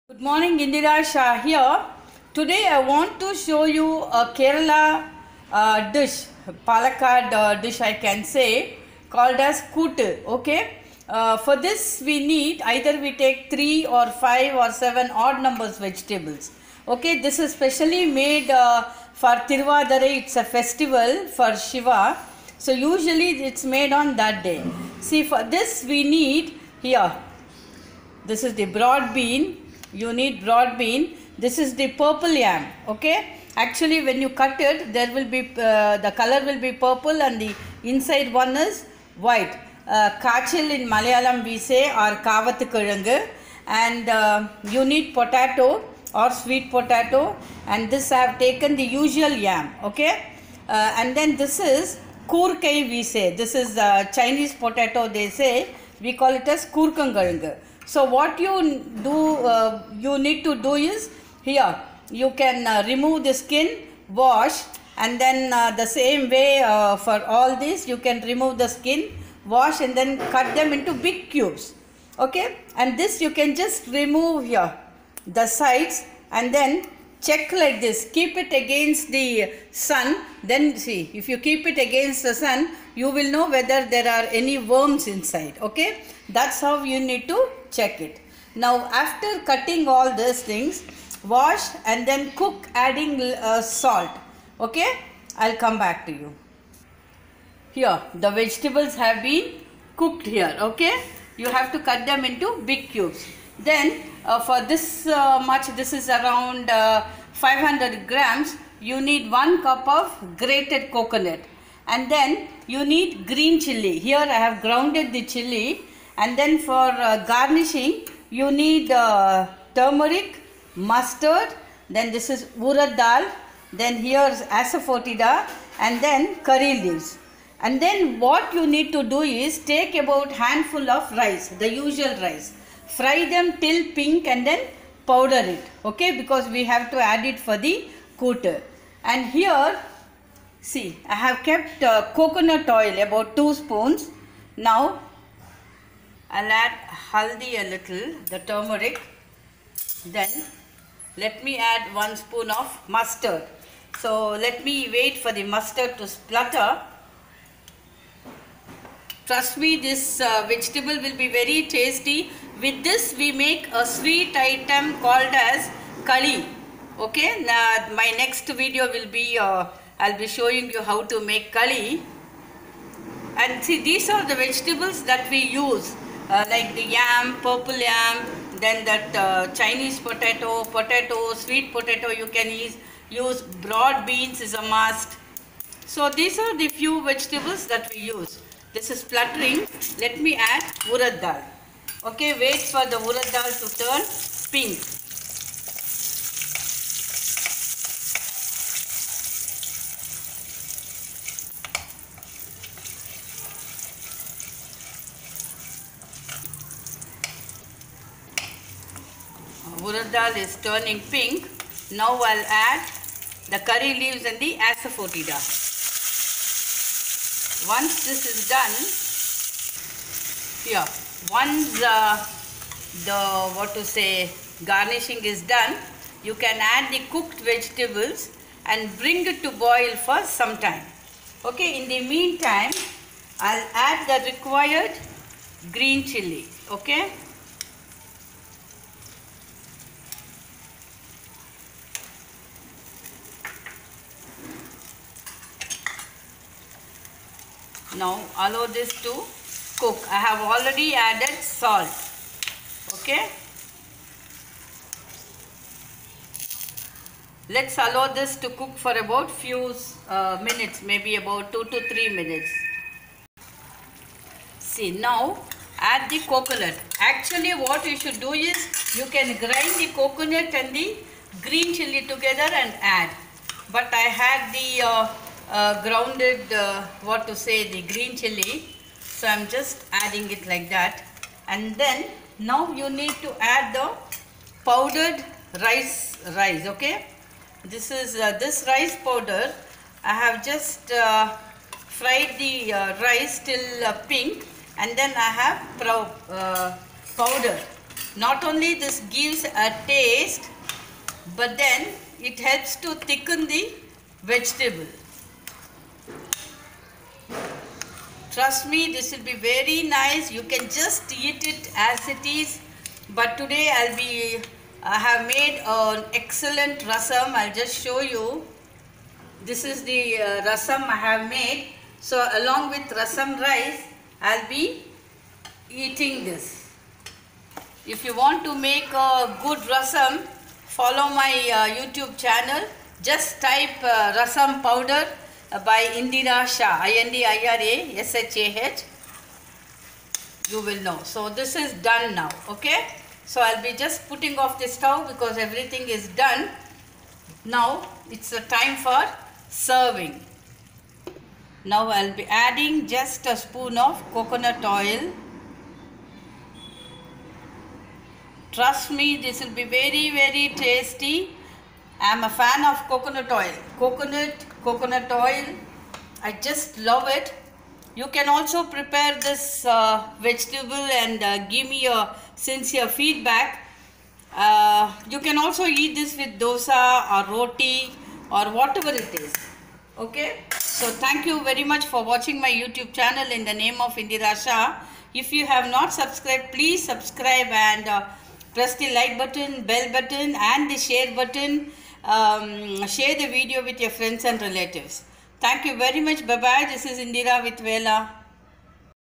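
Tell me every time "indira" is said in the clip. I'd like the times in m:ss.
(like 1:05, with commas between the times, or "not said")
0:00, 5:35, 6:24, 6:36.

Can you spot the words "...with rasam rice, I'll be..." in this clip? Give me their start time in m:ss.
5:22.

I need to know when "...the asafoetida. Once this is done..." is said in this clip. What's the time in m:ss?
3:34.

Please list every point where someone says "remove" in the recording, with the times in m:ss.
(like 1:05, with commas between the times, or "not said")
1:02, 1:08, 1:13.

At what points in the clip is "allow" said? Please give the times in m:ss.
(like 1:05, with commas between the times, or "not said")
4:08, 4:17.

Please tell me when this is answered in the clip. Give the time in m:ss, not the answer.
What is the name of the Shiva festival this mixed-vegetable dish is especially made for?
0:19.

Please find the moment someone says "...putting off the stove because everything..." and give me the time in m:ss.
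5:44.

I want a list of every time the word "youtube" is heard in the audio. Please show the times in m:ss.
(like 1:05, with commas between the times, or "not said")
5:31, 6:22.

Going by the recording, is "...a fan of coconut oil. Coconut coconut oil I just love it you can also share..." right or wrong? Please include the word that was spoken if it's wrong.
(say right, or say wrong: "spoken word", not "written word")
wrong: "prepare", not "share".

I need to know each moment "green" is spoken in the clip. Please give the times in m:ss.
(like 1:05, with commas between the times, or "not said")
1:53, 3:55, 4:31, 4:37.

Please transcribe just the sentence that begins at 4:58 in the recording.
Not only this gives a taste, but then it helps to thicken the vegetable.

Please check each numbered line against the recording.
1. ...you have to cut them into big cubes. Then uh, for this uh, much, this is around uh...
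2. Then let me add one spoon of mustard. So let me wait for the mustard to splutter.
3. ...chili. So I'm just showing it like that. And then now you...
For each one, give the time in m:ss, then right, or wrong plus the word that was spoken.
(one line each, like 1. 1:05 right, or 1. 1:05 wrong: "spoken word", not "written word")
1. 1:41 right
2. 2:30 right
3. 4:38 wrong: "adding", not "showing".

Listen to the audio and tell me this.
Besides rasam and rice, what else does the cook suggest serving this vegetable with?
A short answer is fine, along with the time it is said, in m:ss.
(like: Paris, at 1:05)
dosa, at 6:16.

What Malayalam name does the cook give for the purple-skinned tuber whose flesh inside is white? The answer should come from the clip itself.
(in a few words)
kachil.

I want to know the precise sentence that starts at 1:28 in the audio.
Now after cutting all these things, wash and then cook adding uh, salt.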